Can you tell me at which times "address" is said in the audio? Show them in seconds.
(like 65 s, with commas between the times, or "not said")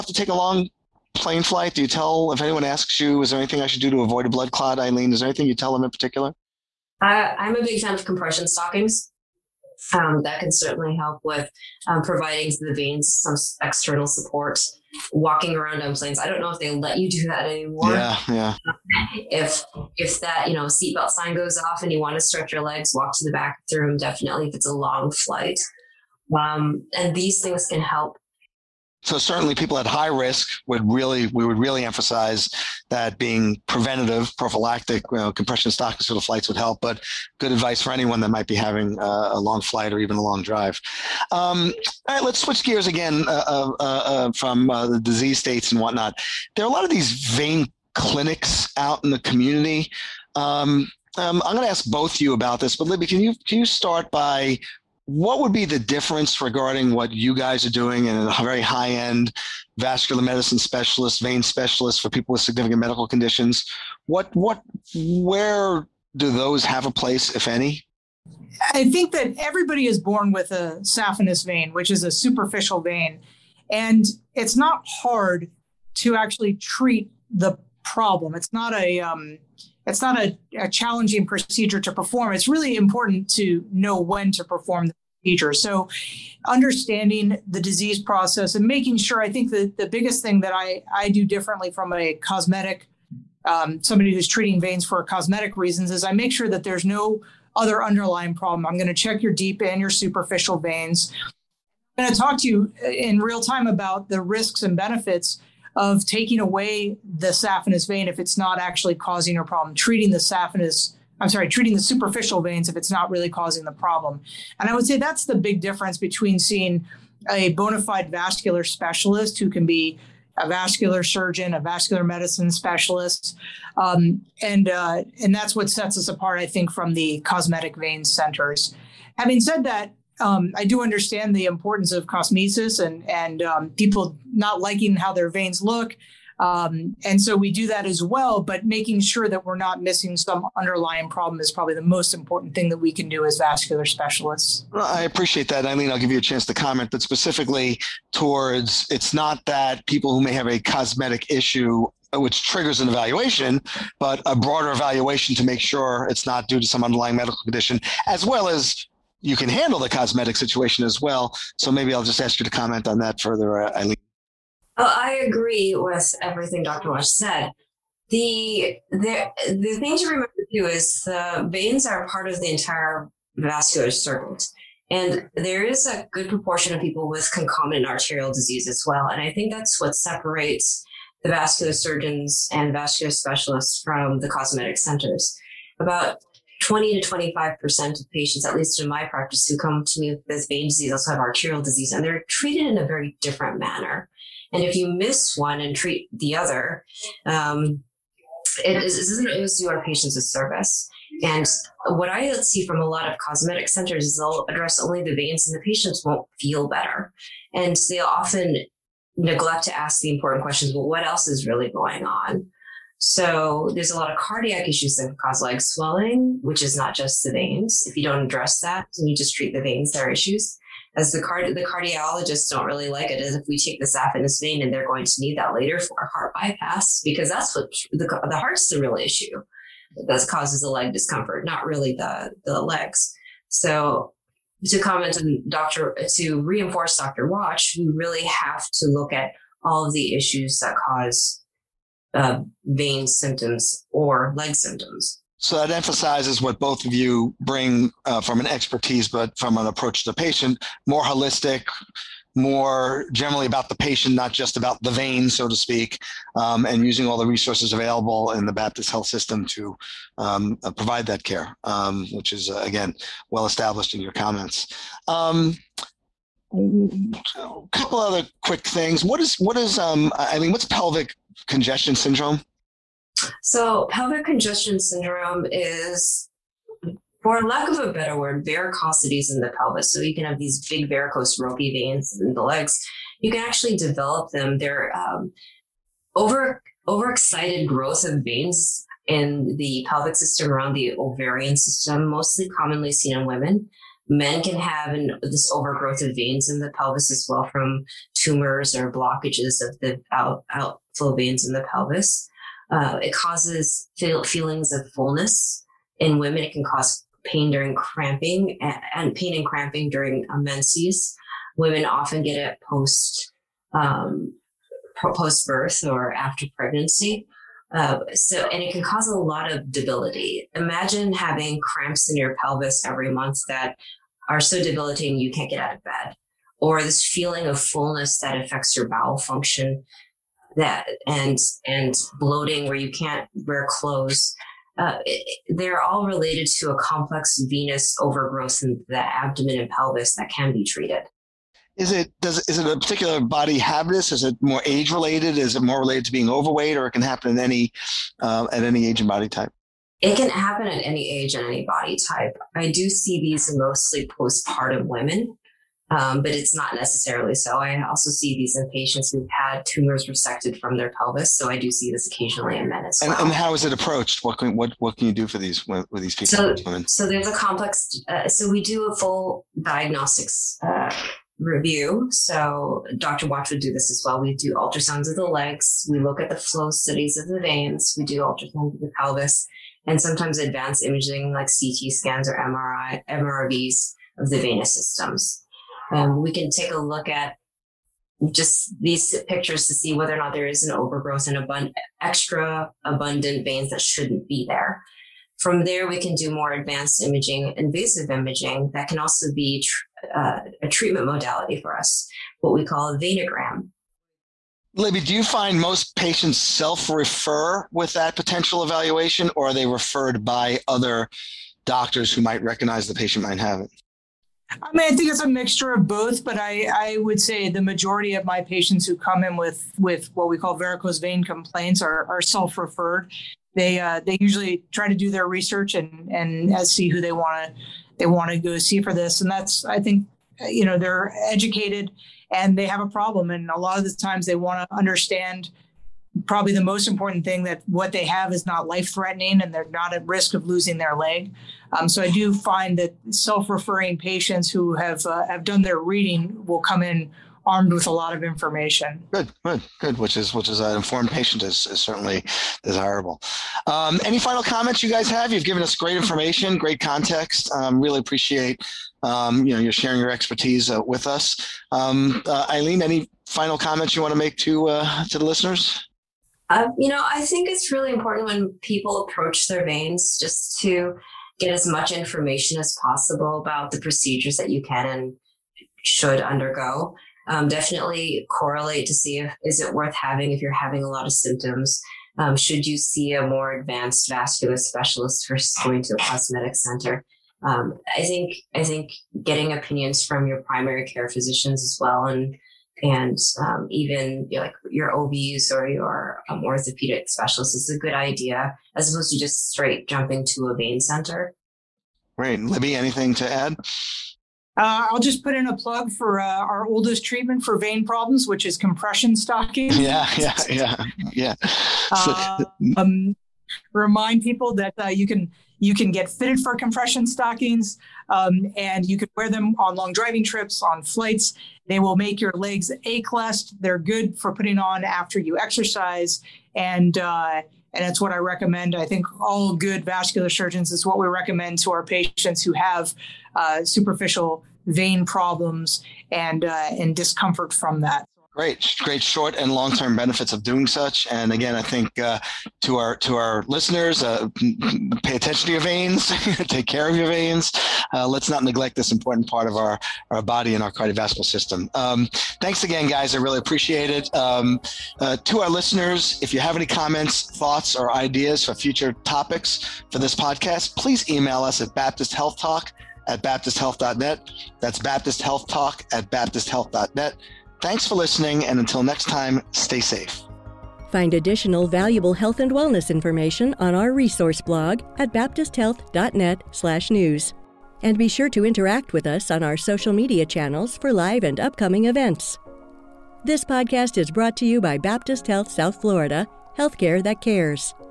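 204 s, 218 s.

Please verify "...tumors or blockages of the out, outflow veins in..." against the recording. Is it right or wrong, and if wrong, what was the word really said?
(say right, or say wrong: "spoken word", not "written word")
right.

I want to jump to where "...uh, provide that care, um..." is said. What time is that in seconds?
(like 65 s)
260 s.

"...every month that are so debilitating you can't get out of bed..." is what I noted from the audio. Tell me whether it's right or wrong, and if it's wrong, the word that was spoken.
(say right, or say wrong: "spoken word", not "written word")
right.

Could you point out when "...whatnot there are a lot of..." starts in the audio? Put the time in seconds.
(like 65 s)
45 s.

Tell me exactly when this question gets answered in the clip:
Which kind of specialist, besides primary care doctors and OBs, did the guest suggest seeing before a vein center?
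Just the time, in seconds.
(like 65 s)
496 s.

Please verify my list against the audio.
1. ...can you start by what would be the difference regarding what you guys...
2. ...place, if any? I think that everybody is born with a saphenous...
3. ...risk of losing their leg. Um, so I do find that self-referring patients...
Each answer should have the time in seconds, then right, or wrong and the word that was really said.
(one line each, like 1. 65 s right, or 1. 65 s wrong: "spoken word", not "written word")
1. 53 s right
2. 66 s right
3. 440 s right.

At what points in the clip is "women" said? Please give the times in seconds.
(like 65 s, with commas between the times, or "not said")
293 s, 306 s, 311 s, 354 s, 366 s.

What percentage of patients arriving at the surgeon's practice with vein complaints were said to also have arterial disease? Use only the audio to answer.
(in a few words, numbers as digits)
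20 to 25%.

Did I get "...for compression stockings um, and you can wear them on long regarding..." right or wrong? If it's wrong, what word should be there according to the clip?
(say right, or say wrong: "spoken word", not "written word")
wrong: "driving", not "regarding".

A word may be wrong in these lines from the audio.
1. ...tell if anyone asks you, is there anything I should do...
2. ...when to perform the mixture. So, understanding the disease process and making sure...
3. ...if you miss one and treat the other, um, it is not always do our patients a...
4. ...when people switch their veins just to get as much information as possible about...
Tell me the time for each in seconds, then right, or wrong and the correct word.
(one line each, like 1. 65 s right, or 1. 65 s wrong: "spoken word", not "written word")
1. 1 s right
2. 83 s wrong: "procedure", not "mixture"
3. 194 s right
4. 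468 s wrong: "approach", not "switch".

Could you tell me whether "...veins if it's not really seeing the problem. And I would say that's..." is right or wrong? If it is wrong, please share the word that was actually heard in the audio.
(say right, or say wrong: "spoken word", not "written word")
wrong: "causing", not "seeing".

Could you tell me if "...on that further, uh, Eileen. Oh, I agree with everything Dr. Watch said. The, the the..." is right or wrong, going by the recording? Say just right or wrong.
right.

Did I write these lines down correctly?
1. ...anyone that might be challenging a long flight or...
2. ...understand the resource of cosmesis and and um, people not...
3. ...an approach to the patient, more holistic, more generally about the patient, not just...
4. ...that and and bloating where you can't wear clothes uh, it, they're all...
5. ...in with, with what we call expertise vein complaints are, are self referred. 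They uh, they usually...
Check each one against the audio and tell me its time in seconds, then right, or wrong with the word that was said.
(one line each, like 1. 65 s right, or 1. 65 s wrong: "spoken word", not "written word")
1. 37 s wrong: "having", not "challenging"
2. 130 s wrong: "importance", not "resource"
3. 249 s right
4. 330 s right
5. 419 s wrong: "varicose", not "expertise".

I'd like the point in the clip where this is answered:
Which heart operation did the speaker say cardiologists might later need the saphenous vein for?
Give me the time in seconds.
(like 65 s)
226 s.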